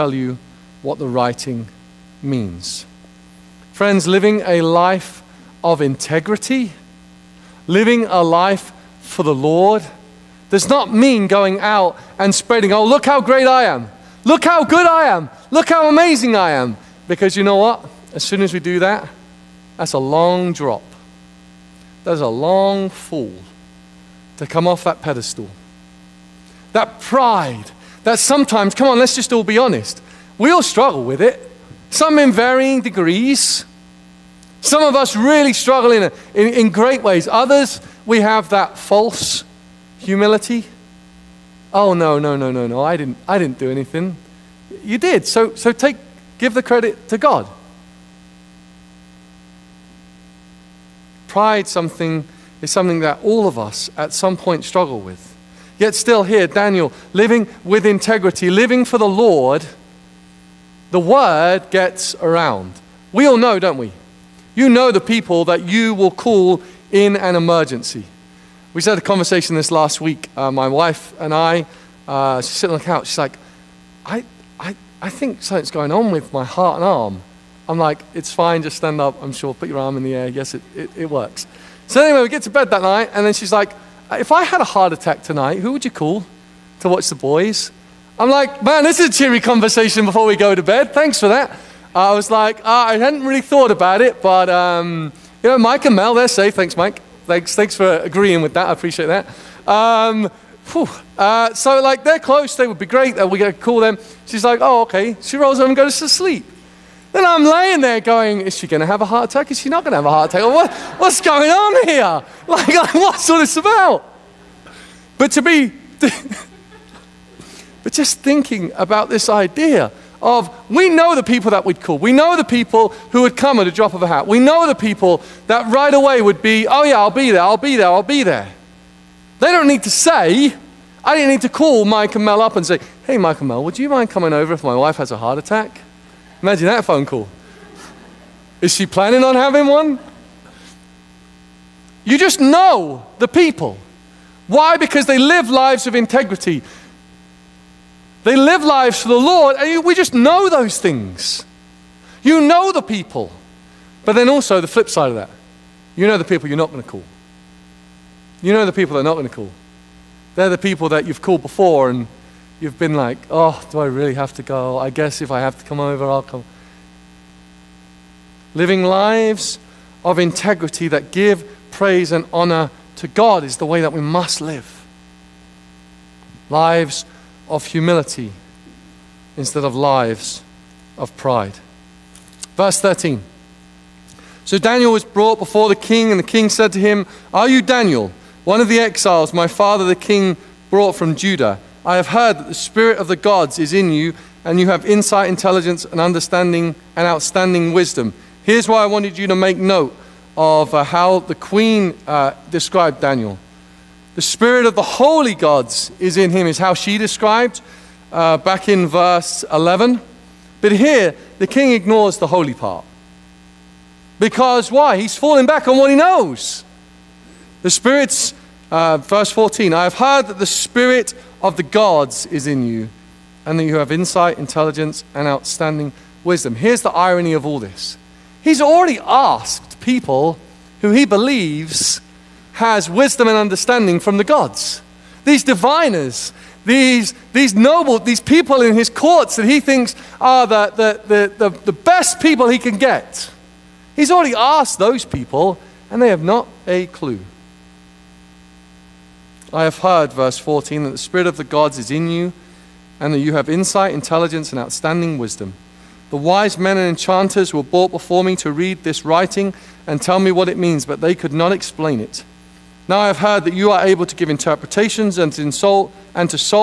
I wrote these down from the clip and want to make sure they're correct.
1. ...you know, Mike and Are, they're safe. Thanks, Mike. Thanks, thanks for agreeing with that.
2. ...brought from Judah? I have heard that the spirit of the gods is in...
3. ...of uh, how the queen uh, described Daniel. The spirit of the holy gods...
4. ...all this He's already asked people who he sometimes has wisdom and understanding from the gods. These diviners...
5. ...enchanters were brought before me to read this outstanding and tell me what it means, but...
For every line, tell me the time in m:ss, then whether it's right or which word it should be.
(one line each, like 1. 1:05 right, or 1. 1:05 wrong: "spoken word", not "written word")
1. 1:35 wrong: "Mel", not "Are"
2. 3:10 right
3. 3:20 right
4. 3:47 wrong: "believes", not "sometimes"
5. 4:16 wrong: "writing", not "outstanding".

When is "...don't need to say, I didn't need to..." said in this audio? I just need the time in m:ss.
2:09.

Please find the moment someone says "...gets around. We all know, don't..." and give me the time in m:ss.
1:01.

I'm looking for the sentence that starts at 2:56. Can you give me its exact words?
Lives of humility instead of lives of pride.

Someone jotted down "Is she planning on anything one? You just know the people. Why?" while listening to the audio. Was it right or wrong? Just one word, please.
wrong.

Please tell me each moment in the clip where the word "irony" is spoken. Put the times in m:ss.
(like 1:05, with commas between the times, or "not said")
3:46.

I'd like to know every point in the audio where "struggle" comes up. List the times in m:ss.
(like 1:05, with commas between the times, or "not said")
0:30, 0:35, 0:54.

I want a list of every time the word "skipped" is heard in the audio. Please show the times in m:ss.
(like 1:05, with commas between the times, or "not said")
not said.